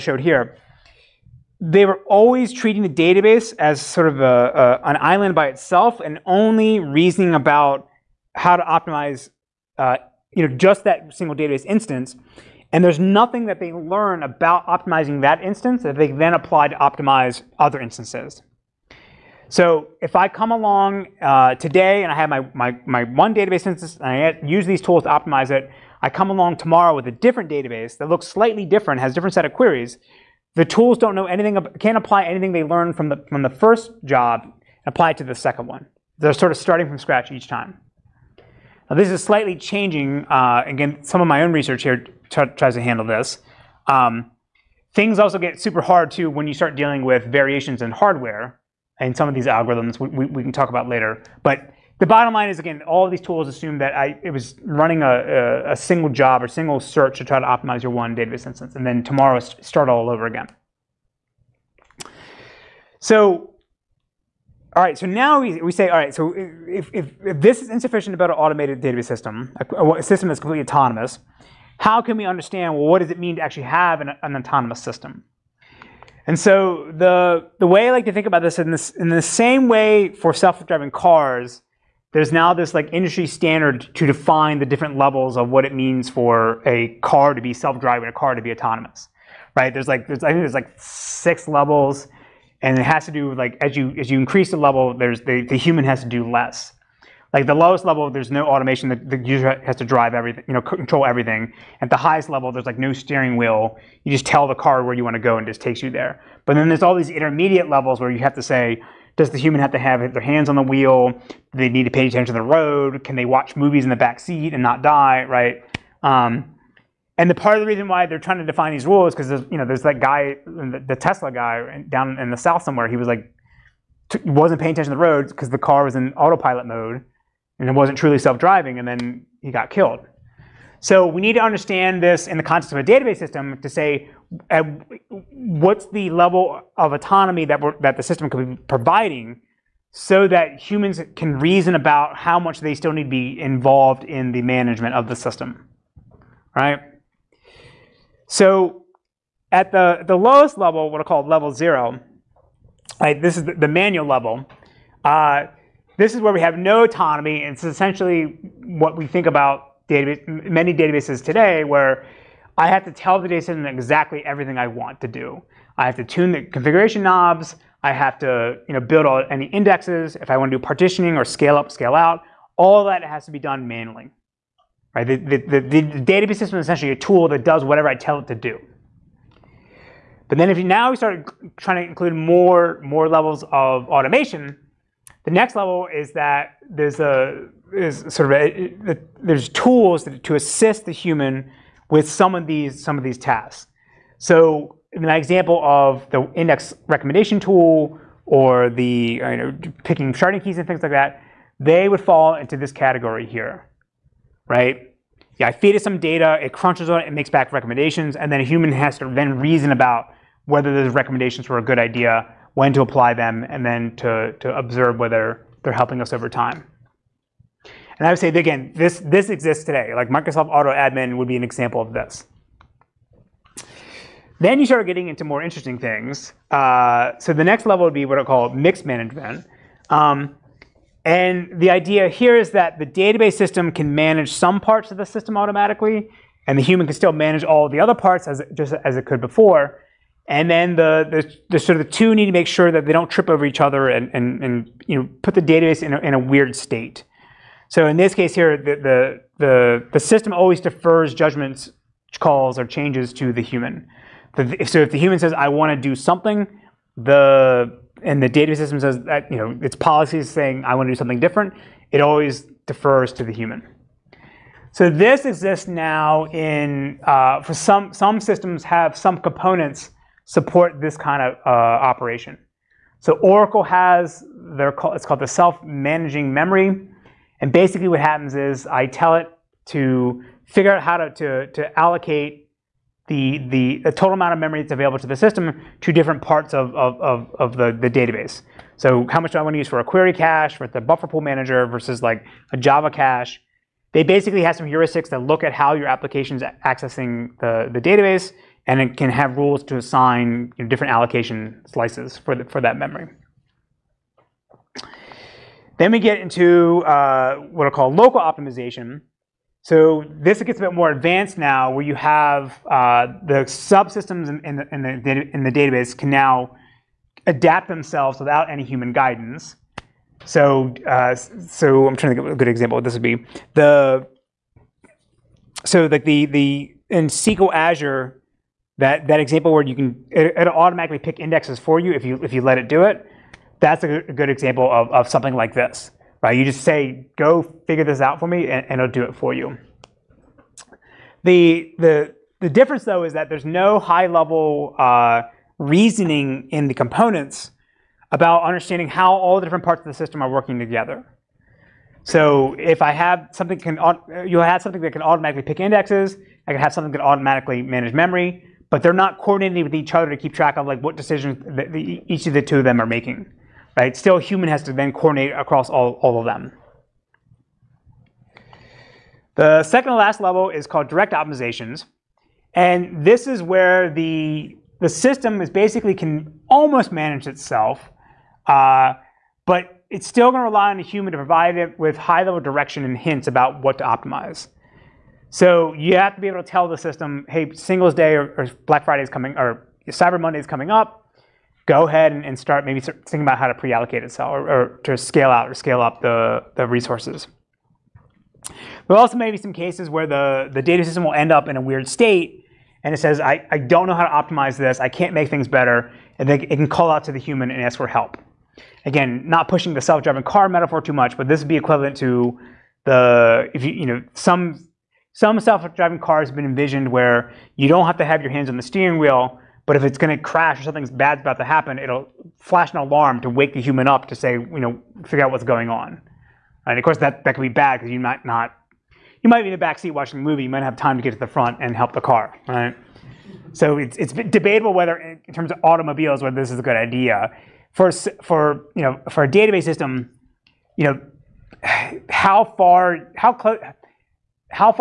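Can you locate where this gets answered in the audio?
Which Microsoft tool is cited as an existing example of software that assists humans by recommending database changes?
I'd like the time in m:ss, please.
3:40.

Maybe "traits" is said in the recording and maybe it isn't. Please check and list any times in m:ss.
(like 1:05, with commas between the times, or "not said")
not said.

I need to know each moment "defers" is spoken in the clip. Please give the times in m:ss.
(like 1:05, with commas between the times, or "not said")
4:10, 4:22.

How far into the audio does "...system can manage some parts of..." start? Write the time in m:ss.
3:53.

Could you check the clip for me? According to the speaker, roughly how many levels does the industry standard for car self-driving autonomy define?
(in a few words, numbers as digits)
6.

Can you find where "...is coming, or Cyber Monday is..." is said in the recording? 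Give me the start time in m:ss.
6:29.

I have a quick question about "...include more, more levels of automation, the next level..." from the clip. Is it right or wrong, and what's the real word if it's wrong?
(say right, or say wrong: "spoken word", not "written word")
right.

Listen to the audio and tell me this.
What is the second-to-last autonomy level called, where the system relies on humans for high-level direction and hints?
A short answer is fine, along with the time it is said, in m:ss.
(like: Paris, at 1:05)
direct optimizations, at 6:10.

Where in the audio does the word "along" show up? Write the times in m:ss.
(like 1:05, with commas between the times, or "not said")
0:20, 0:26.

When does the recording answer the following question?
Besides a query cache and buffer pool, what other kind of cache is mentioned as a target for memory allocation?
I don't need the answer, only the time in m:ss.
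4:52.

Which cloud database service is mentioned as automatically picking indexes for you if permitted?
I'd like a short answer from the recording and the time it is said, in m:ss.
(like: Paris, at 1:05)
SQL Azure, at 5:27.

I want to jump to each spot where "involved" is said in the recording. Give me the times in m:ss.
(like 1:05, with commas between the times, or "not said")
2:23.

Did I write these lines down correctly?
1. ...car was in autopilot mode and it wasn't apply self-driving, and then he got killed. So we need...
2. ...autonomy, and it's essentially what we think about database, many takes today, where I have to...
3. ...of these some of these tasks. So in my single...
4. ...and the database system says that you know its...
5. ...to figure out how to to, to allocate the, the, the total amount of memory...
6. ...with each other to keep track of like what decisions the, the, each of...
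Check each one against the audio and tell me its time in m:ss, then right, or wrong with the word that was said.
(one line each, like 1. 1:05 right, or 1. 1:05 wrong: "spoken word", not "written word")
1. 2:05 wrong: "truly", not "apply"
2. 2:36 wrong: "databases", not "takes"
3. 3:12 wrong: "example", not "single"
4. 4:18 right
5. 4:39 right
6. 5:59 right.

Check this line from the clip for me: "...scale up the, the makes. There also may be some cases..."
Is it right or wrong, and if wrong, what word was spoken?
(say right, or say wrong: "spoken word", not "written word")
wrong: "resources", not "makes".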